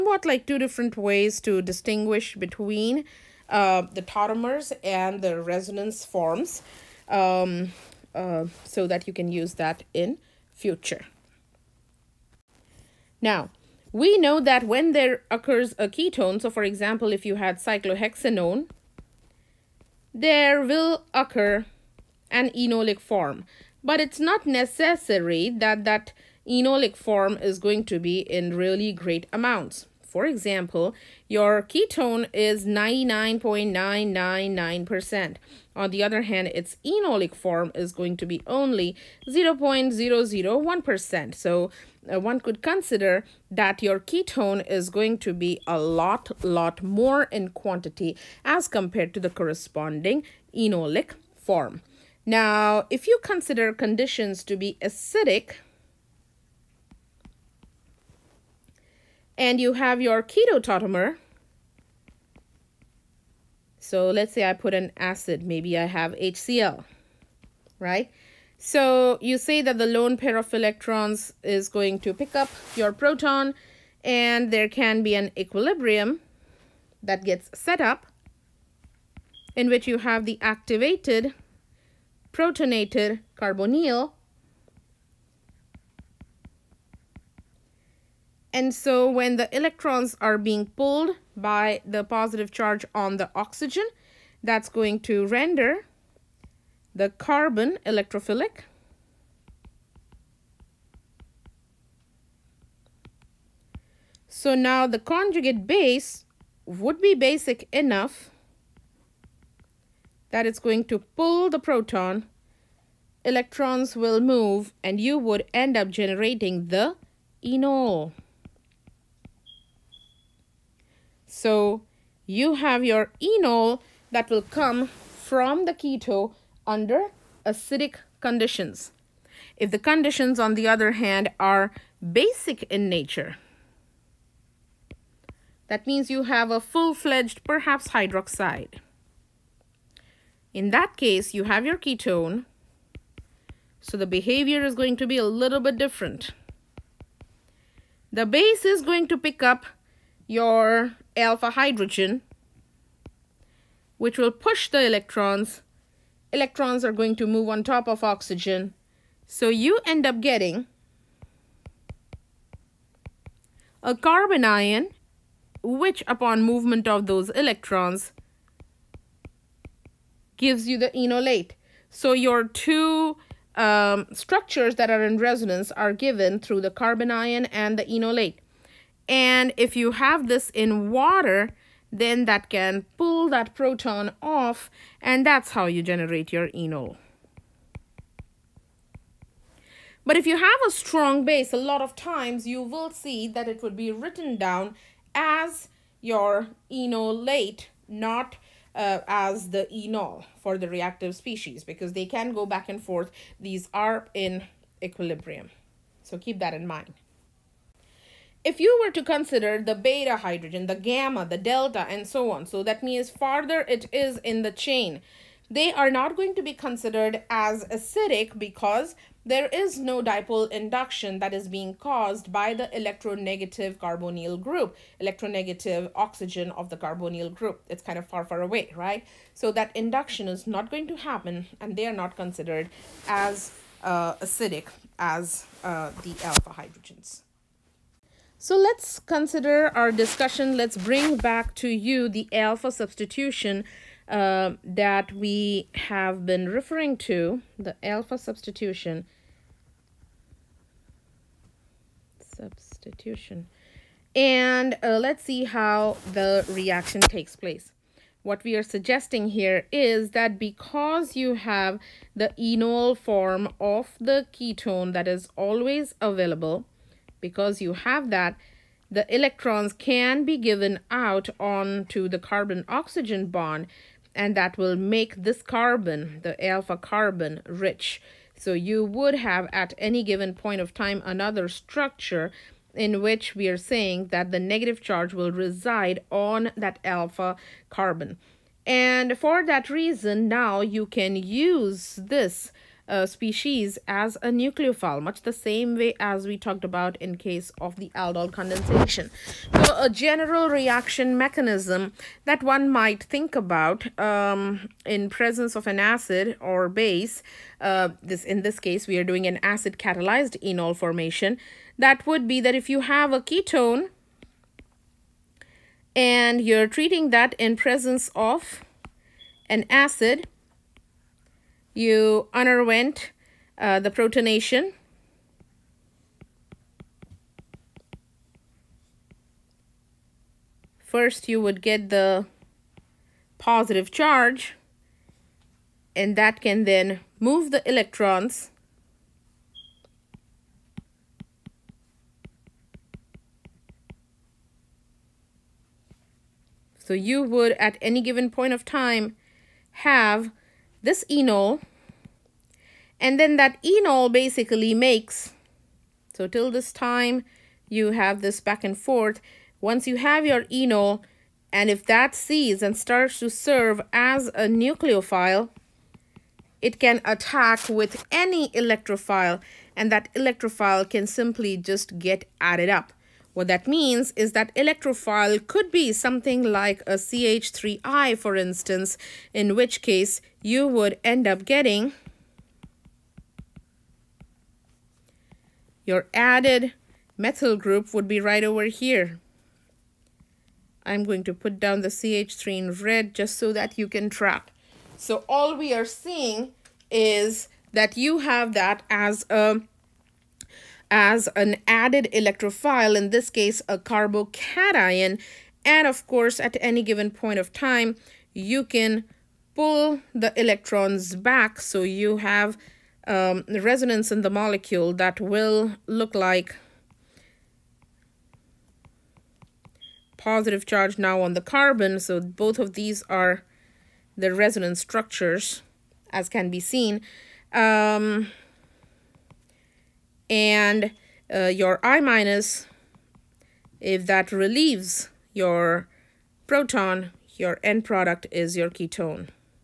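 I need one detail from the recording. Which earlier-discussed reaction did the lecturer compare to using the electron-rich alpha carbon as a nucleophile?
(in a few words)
aldol condensation.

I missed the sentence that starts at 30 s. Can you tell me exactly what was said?
For example, your ketone is 99.999%.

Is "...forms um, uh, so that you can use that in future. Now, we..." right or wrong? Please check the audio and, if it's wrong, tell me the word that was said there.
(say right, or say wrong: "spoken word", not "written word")
right.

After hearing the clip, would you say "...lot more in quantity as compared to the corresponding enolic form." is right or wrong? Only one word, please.
right.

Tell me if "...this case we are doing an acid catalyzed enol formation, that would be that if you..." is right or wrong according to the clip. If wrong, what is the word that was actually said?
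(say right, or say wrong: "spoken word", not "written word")
right.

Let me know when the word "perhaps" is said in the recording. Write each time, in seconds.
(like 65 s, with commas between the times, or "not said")
137 s.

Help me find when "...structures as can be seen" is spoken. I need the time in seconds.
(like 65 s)
424 s.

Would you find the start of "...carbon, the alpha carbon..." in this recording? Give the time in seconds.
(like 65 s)
275 s.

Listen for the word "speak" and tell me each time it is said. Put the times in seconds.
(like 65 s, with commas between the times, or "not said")
not said.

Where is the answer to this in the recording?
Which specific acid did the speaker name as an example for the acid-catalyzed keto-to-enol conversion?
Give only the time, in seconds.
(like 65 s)
66 s.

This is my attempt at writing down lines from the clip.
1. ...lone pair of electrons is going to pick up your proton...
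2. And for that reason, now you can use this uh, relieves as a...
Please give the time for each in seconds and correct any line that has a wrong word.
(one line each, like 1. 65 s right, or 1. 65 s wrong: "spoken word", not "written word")
1. 69 s right
2. 288 s wrong: "species", not "relieves".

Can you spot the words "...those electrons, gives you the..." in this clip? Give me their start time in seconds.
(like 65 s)
167 s.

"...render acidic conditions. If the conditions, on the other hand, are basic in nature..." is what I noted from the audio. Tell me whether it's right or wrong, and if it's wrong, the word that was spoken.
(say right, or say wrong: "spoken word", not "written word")
wrong: "under", not "render".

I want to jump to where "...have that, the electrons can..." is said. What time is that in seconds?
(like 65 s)
267 s.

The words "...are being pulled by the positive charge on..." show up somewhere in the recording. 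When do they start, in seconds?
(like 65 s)
90 s.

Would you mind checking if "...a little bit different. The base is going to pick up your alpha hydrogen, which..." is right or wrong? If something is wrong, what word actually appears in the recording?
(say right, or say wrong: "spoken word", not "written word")
right.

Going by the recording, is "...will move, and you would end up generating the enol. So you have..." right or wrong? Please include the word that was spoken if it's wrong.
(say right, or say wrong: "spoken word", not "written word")
right.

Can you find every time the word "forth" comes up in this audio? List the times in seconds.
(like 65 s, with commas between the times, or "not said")
202 s, 358 s.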